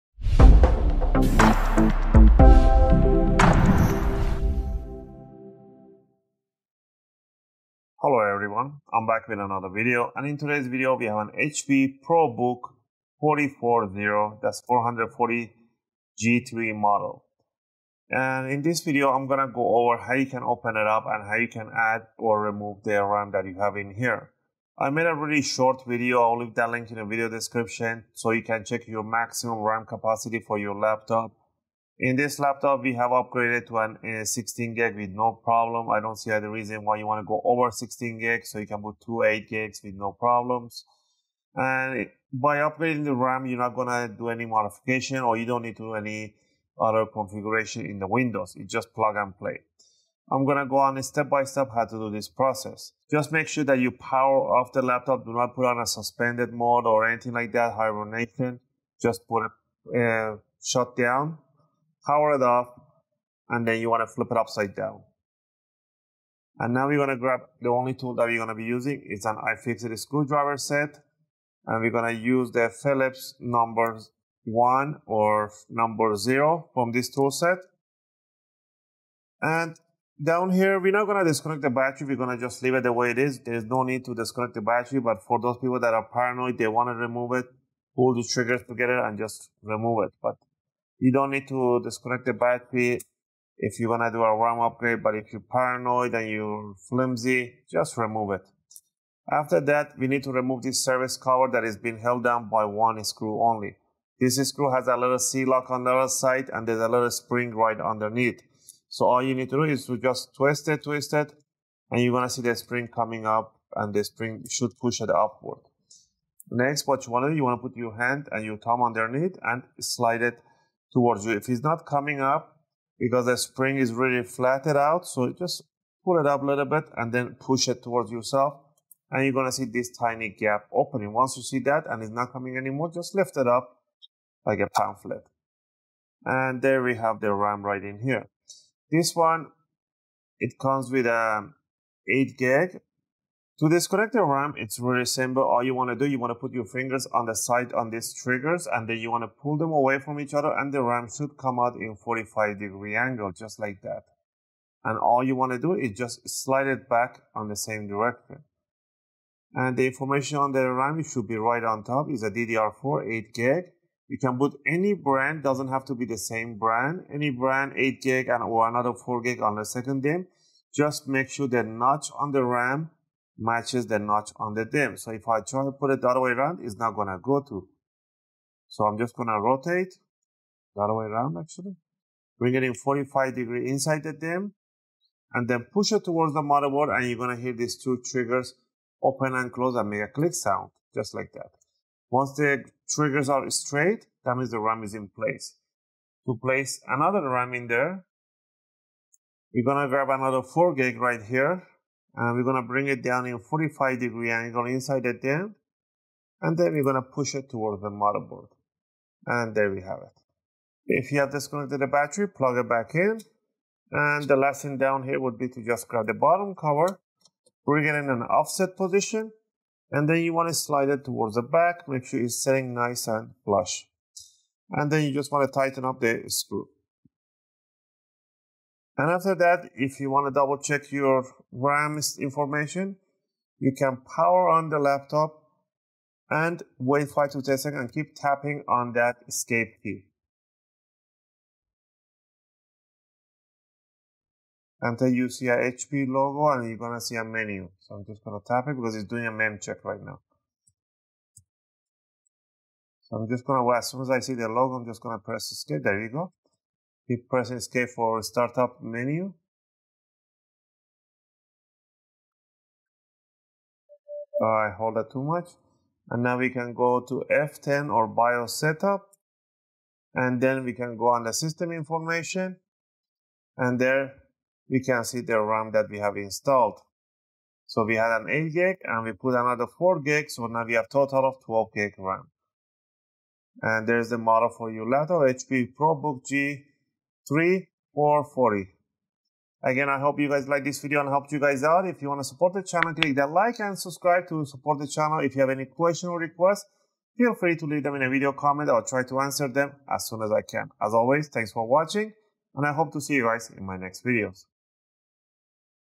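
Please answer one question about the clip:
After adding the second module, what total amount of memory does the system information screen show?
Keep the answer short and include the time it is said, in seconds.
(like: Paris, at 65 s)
12 GB, at 281 s.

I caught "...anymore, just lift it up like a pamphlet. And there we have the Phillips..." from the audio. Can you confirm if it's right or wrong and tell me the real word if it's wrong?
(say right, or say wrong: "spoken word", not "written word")
wrong: "RAM", not "Phillips".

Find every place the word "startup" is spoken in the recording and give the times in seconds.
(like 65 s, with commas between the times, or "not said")
258 s.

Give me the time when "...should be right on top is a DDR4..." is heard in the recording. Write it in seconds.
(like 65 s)
161 s.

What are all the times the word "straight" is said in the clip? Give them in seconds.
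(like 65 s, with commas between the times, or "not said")
193 s.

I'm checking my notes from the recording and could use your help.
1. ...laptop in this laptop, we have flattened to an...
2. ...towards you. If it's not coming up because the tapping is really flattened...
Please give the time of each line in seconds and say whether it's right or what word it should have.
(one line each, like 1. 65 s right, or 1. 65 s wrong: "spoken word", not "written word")
1. 30 s wrong: "upgraded", not "flattened"
2. 120 s wrong: "spring", not "tapping".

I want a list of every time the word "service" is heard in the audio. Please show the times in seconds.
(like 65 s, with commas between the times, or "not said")
100 s.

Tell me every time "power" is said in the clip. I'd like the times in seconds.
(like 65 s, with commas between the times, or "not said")
53 s, 62 s, 234 s.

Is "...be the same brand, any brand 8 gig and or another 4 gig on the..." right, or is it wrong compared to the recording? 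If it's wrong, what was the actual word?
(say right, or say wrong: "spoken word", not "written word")
right.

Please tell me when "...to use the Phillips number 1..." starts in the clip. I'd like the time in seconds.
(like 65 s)
72 s.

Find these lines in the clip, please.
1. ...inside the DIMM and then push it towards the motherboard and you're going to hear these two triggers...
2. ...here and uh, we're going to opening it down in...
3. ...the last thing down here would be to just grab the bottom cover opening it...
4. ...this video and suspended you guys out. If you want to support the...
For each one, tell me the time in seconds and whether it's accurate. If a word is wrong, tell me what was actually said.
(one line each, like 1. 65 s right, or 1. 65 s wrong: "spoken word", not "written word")
1. 183 s right
2. 201 s wrong: "bring", not "opening"
3. 214 s wrong: "bring", not "opening"
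4. 290 s wrong: "helped", not "suspended".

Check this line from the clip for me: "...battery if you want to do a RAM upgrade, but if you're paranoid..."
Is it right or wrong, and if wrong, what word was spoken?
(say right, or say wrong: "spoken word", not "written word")
right.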